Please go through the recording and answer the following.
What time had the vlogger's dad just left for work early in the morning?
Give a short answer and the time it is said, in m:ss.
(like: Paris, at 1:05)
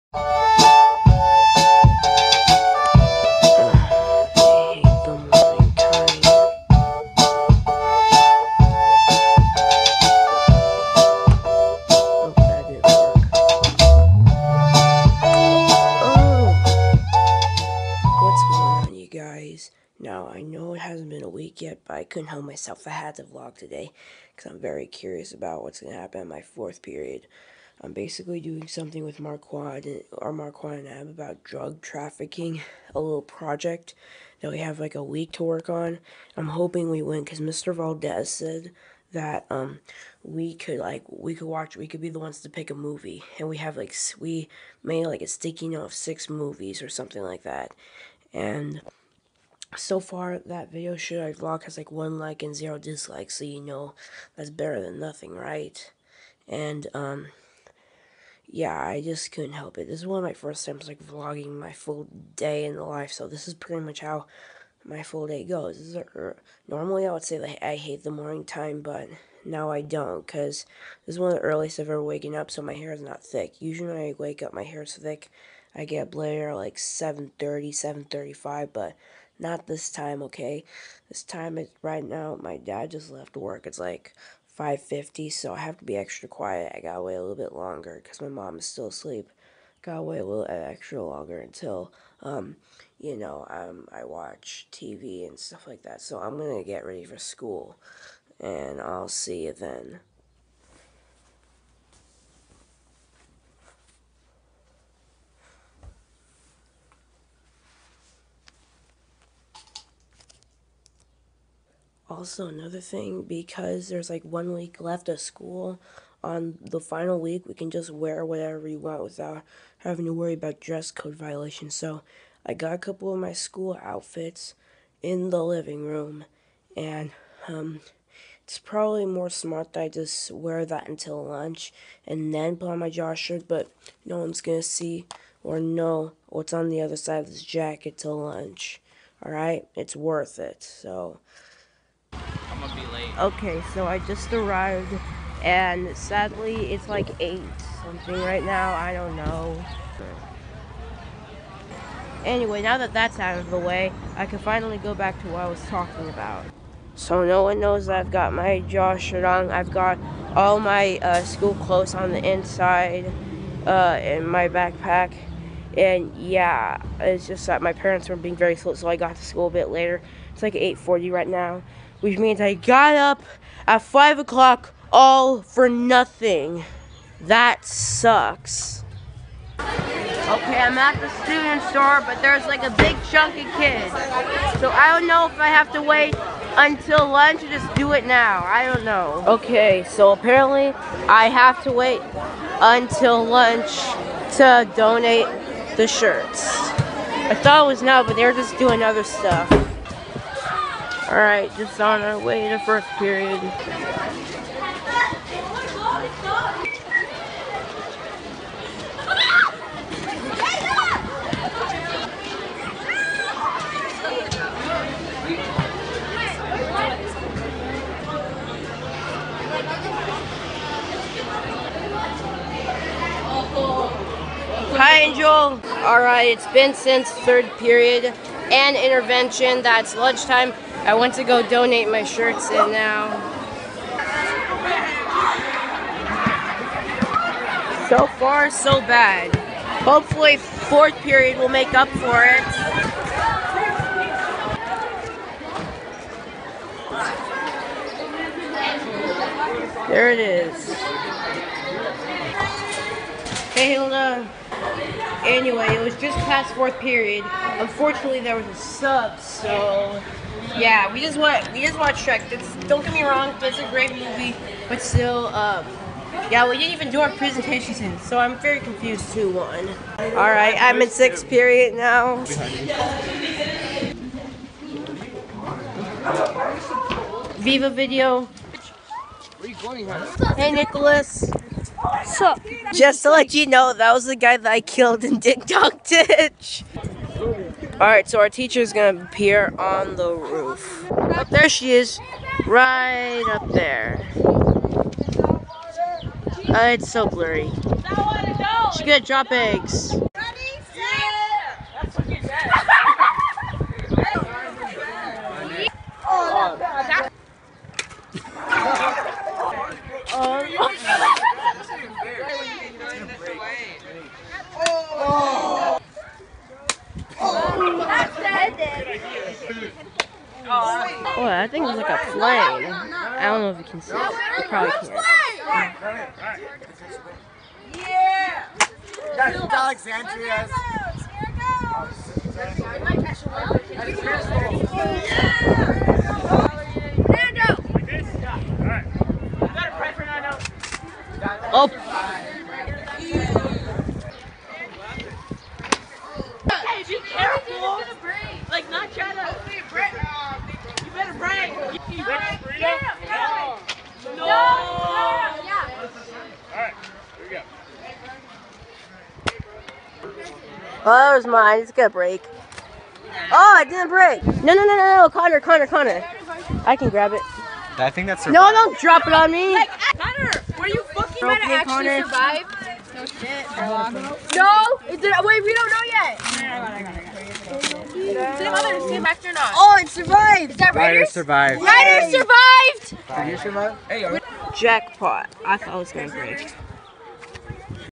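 5:50, at 1:24.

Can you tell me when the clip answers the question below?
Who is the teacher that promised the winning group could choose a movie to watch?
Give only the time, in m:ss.
0:37.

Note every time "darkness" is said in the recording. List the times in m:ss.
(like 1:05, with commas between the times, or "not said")
not said.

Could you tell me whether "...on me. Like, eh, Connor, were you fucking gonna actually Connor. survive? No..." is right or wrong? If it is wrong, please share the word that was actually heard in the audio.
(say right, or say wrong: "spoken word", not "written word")
right.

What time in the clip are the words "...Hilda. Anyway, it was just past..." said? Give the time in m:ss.
4:13.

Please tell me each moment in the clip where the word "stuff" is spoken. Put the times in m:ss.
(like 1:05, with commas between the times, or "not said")
1:35, 3:19.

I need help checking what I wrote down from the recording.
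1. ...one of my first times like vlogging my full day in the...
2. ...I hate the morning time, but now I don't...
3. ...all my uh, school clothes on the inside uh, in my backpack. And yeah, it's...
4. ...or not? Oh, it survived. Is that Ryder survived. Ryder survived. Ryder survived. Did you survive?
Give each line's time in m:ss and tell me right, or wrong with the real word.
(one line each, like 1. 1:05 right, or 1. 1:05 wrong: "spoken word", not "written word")
1. 1:00 right
2. 1:07 right
3. 2:40 right
4. 6:19 right.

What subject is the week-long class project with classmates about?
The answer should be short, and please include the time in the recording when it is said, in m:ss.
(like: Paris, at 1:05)
Drug trafficking, at 0:31.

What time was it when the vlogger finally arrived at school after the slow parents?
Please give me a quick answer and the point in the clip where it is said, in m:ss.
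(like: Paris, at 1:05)
8:40, at 2:50.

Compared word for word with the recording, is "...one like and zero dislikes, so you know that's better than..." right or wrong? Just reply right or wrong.
right.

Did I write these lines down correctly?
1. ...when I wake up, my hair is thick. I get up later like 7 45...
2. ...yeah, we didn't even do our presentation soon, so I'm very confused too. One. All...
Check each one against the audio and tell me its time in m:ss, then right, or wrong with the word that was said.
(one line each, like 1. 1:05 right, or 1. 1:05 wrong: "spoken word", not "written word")
1. 1:13 wrong: "35", not "45"
2. 4:26 right.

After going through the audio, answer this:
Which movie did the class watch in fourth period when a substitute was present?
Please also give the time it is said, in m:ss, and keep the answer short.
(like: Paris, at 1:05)
Shrek, at 4:22.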